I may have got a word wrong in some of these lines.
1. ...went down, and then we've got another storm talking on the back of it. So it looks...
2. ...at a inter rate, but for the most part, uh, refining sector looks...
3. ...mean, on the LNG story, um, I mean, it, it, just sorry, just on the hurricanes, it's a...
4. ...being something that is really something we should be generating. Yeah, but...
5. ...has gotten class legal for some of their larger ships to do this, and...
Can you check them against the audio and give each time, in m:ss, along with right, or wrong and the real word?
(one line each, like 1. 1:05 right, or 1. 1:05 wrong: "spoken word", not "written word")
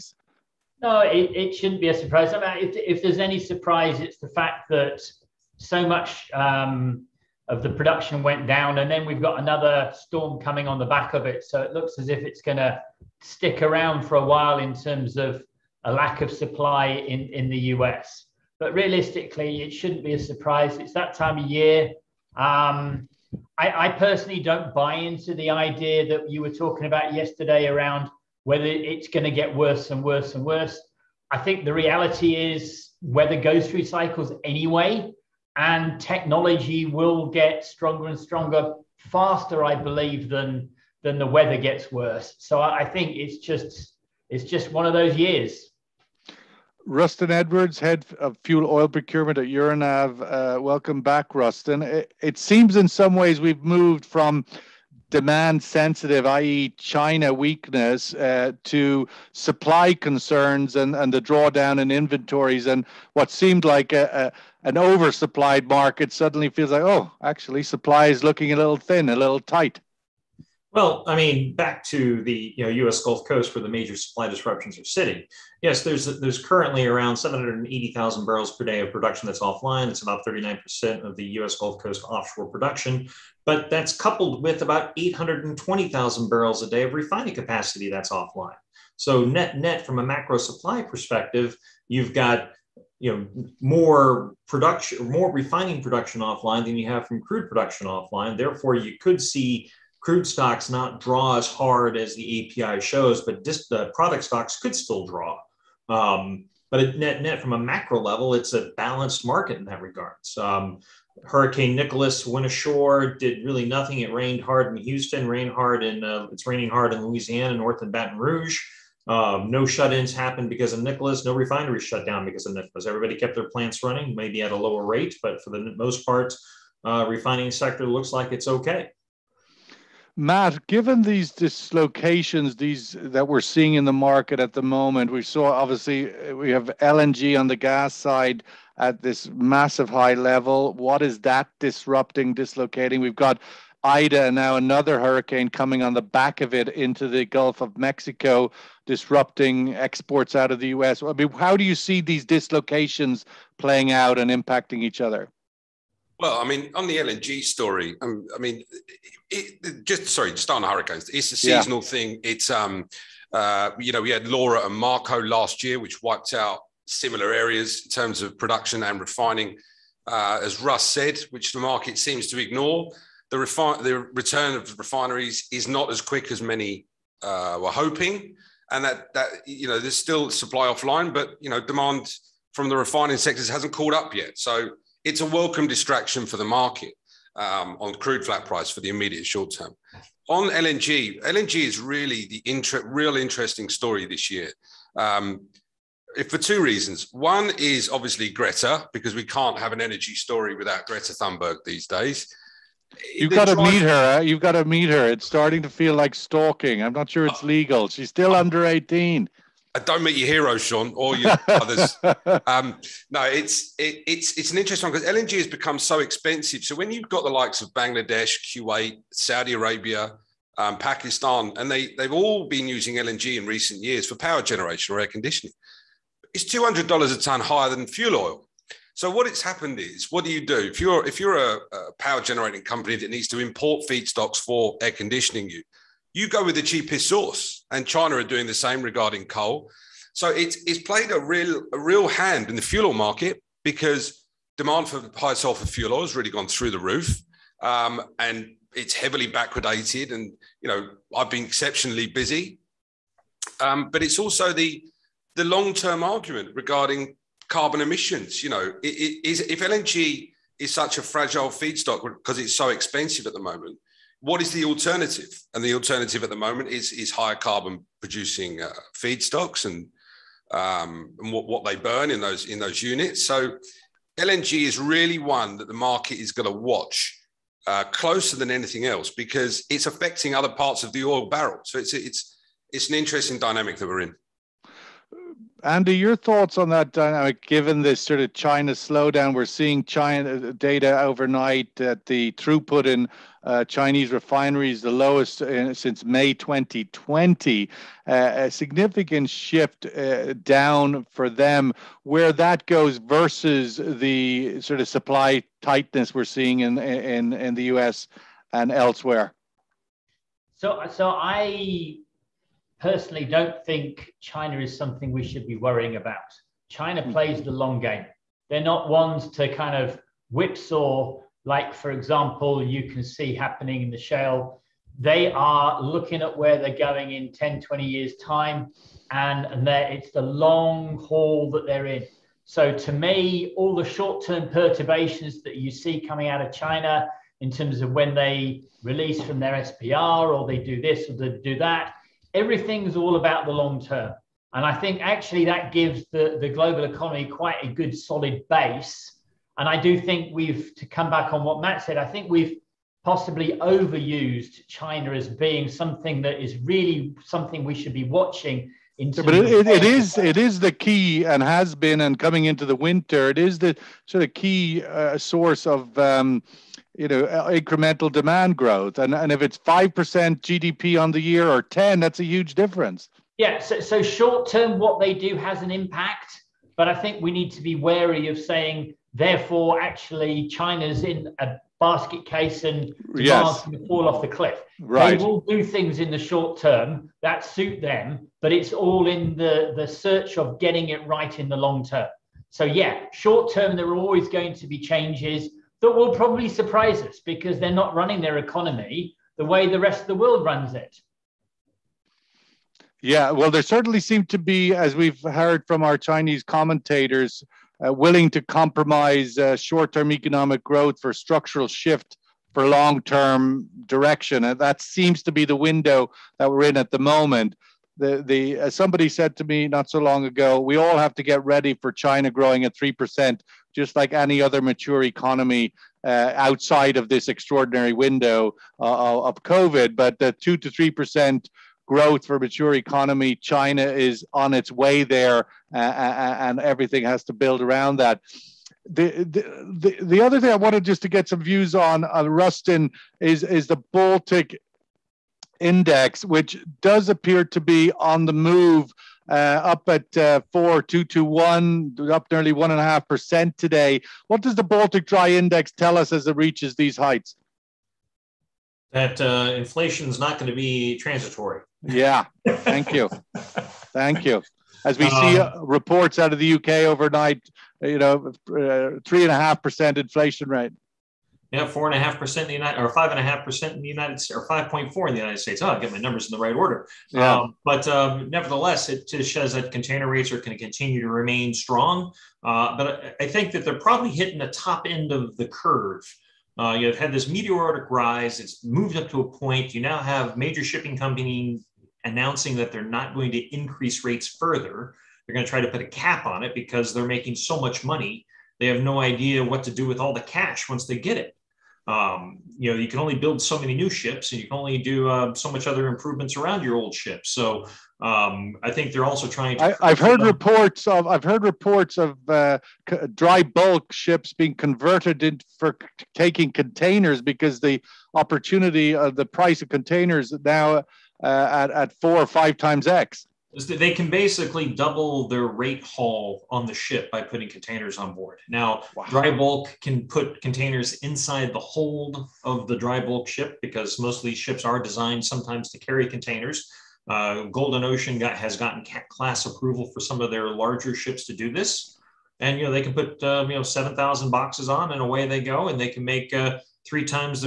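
1. 0:08 wrong: "coming", not "talking"
2. 2:04 wrong: "lower", not "inter"
3. 2:36 right
4. 5:55 wrong: "watching", not "generating"
5. 8:58 wrong: "approval", not "legal".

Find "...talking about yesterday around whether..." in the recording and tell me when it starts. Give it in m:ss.
0:26.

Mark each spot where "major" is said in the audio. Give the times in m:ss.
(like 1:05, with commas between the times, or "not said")
1:13, 8:10.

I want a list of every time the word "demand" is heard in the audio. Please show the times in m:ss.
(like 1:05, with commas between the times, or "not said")
0:55, 3:01, 4:04, 6:08.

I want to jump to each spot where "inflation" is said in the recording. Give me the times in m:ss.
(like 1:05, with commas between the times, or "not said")
7:39, 7:49.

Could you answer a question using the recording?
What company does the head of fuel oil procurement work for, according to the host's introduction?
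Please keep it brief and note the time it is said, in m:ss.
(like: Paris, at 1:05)
Euronav, at 0:49.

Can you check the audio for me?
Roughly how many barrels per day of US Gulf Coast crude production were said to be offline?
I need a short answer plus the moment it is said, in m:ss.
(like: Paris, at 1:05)
780,000 barrels per day, at 1:17.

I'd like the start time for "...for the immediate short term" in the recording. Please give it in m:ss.
3:08.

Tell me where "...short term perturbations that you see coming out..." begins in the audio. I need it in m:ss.
5:33.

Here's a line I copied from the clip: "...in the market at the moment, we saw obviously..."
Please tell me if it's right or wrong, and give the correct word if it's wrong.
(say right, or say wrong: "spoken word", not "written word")
right.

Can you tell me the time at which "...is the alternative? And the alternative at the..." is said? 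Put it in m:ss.
4:24.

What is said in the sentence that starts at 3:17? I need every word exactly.
One is obviously Greta, because we can't have an energy story without Greta Thunberg these days.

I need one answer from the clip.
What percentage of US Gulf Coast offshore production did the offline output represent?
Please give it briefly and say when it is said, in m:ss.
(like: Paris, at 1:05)
39%, at 1:20.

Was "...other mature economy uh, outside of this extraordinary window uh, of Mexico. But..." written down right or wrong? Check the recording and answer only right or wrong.
wrong.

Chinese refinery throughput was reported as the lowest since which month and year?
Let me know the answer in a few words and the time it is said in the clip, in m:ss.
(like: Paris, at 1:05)
May 2020, at 4:56.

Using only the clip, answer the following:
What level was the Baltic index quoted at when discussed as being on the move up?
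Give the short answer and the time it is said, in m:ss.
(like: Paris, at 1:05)
4221, at 7:30.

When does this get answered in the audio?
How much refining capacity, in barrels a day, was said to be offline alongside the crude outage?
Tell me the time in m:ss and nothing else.
1:24.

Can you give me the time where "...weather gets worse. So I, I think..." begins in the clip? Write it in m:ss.
0:41.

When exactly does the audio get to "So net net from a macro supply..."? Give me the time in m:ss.
1:28.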